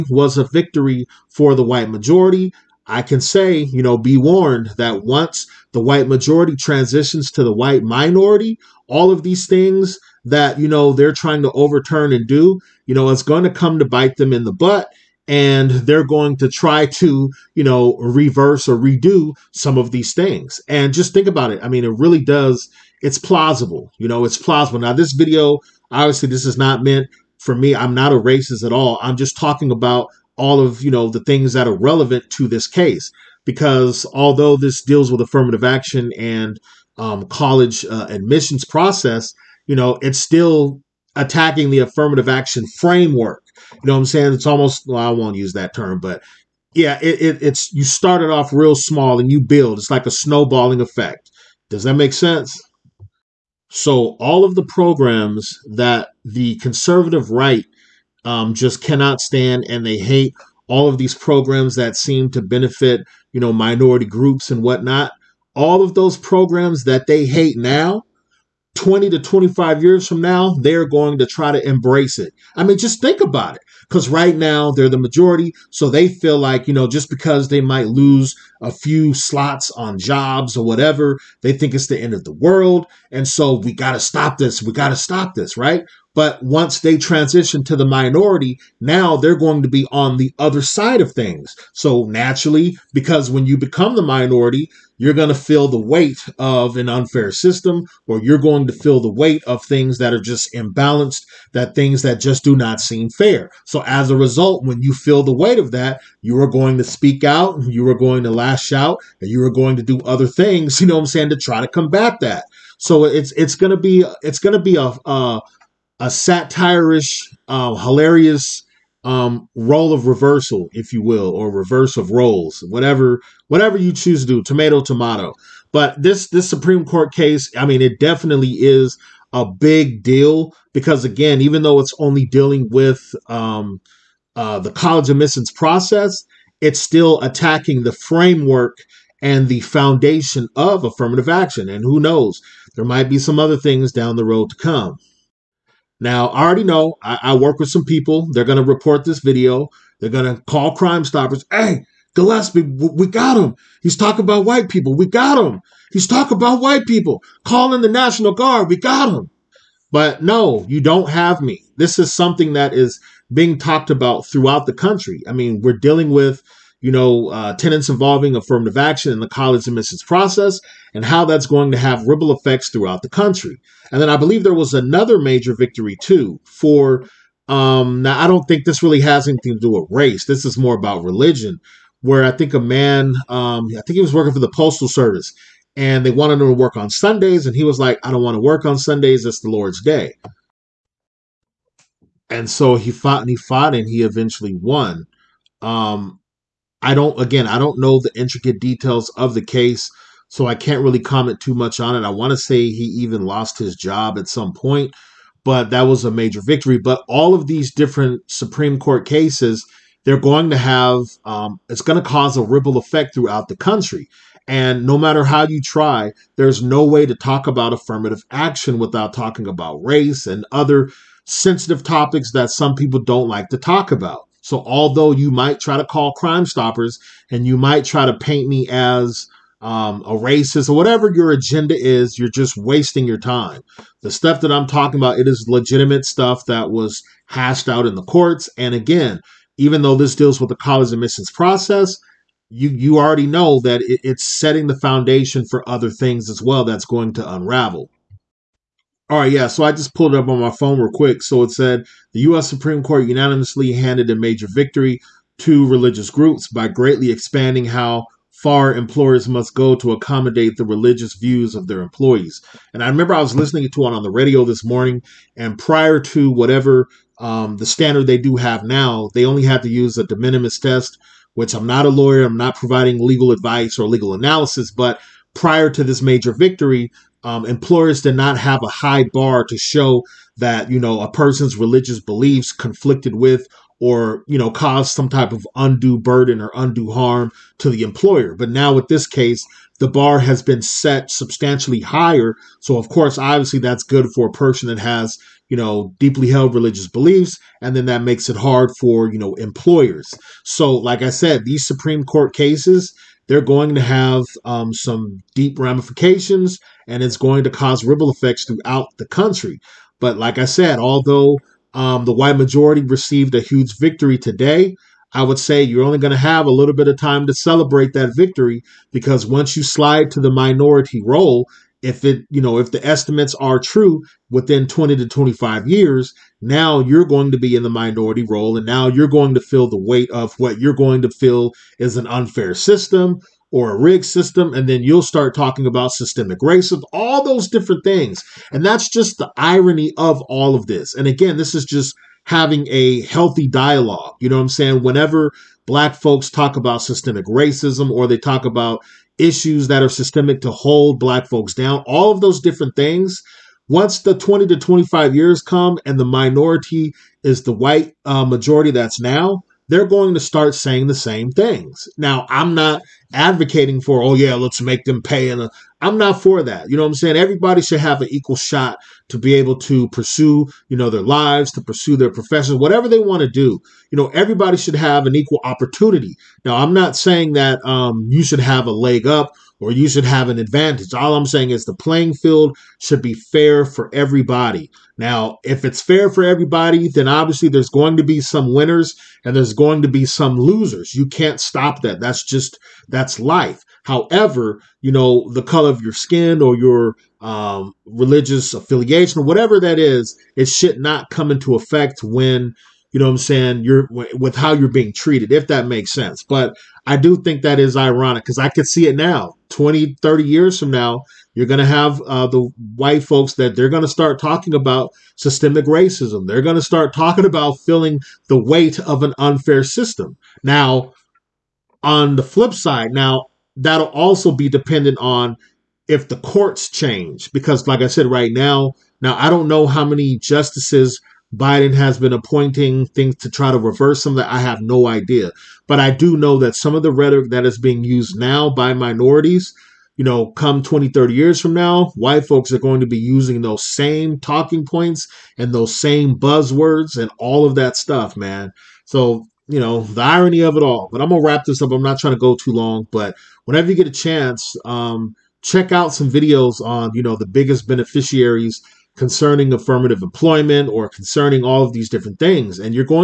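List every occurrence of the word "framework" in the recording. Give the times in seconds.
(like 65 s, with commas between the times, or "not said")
42 s, 137 s.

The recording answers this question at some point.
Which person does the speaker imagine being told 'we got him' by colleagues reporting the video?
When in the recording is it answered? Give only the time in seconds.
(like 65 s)
152 s.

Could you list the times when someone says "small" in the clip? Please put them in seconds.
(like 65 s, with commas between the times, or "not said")
48 s.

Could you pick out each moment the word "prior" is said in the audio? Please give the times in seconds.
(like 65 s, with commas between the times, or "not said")
265 s, 275 s.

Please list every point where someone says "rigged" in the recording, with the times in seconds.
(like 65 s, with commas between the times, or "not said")
333 s.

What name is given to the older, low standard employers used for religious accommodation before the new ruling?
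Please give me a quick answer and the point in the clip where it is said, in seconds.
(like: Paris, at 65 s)
de minimis test, at 270 s.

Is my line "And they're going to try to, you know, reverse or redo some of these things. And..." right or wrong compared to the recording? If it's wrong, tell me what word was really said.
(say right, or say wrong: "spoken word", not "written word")
right.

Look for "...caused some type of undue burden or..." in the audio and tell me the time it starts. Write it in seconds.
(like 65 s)
284 s.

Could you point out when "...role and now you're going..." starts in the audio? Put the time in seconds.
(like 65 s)
328 s.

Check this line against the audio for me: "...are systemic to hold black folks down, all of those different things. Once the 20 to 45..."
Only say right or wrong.
wrong.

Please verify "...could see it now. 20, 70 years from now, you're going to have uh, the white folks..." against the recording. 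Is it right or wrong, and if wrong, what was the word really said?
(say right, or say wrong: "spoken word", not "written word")
wrong: "30", not "70".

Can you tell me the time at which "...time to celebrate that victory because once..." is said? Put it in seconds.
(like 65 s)
316 s.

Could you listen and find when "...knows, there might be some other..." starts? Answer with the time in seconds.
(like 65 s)
141 s.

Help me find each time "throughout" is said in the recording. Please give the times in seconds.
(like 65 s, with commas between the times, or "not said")
164 s, 172 s, 213 s, 308 s.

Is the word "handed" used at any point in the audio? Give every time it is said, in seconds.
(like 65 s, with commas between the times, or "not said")
253 s.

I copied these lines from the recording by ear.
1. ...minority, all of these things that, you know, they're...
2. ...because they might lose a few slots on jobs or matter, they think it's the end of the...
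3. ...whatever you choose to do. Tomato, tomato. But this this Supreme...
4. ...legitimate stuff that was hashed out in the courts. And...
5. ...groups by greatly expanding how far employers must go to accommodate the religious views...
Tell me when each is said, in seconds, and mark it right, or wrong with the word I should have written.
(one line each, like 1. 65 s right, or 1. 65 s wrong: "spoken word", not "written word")
1. 7 s right
2. 77 s wrong: "whatever", not "matter"
3. 123 s right
4. 235 s right
5. 256 s right.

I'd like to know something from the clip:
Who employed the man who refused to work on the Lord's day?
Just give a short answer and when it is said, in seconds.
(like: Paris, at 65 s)
the postal service, at 184 s.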